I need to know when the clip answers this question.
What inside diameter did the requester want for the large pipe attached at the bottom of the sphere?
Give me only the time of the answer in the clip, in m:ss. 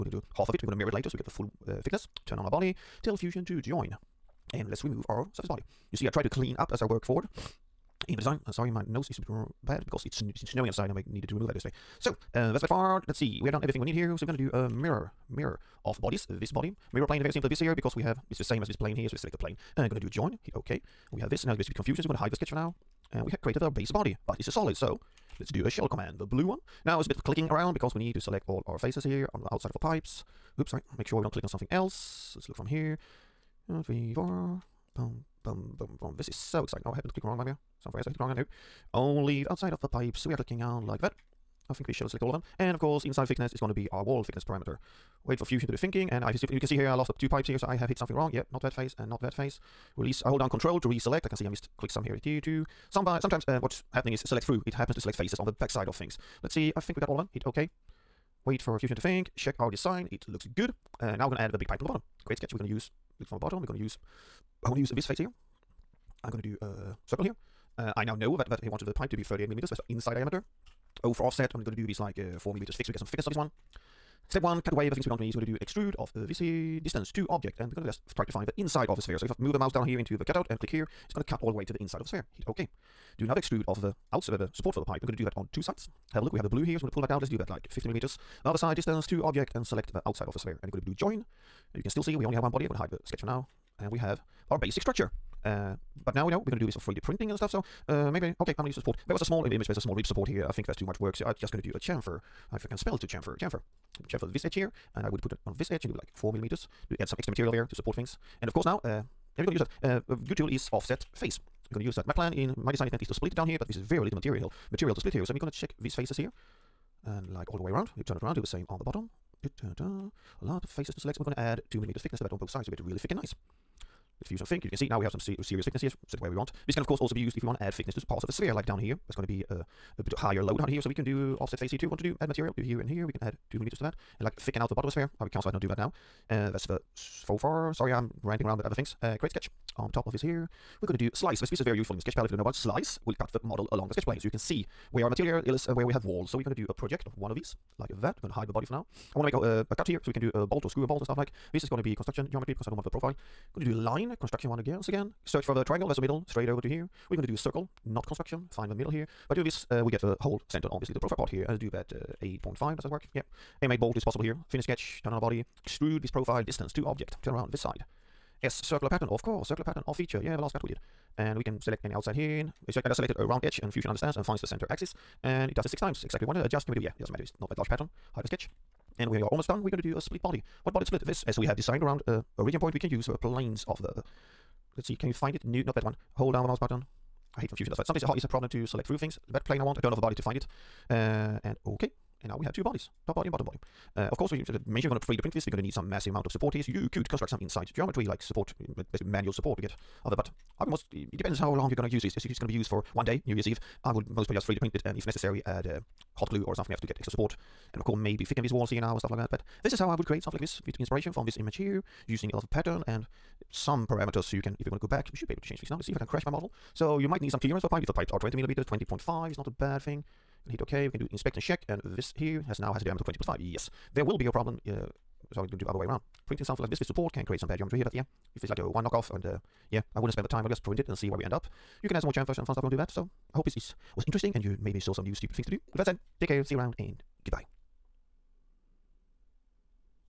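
1:09.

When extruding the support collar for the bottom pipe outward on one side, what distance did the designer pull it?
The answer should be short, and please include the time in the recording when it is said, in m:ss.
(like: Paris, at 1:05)
50 millimeters, at 1:27.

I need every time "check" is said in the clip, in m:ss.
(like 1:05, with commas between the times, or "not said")
0:59, 1:55, 3:41.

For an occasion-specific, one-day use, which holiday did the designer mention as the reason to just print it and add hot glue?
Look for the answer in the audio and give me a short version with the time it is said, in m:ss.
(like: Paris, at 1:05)
New Year's Eve, at 3:23.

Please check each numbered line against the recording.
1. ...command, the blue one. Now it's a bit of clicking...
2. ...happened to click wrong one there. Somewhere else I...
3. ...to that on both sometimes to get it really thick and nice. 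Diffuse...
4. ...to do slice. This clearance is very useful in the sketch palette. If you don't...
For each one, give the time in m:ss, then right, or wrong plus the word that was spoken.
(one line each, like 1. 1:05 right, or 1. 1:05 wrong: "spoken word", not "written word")
1. 0:25 right
2. 0:36 right
3. 2:02 wrong: "sides", not "sometimes"
4. 2:20 wrong: "piece", not "clearance".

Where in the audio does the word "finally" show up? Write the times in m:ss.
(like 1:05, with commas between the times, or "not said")
not said.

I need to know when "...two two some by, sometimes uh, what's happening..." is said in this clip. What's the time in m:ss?
0:52.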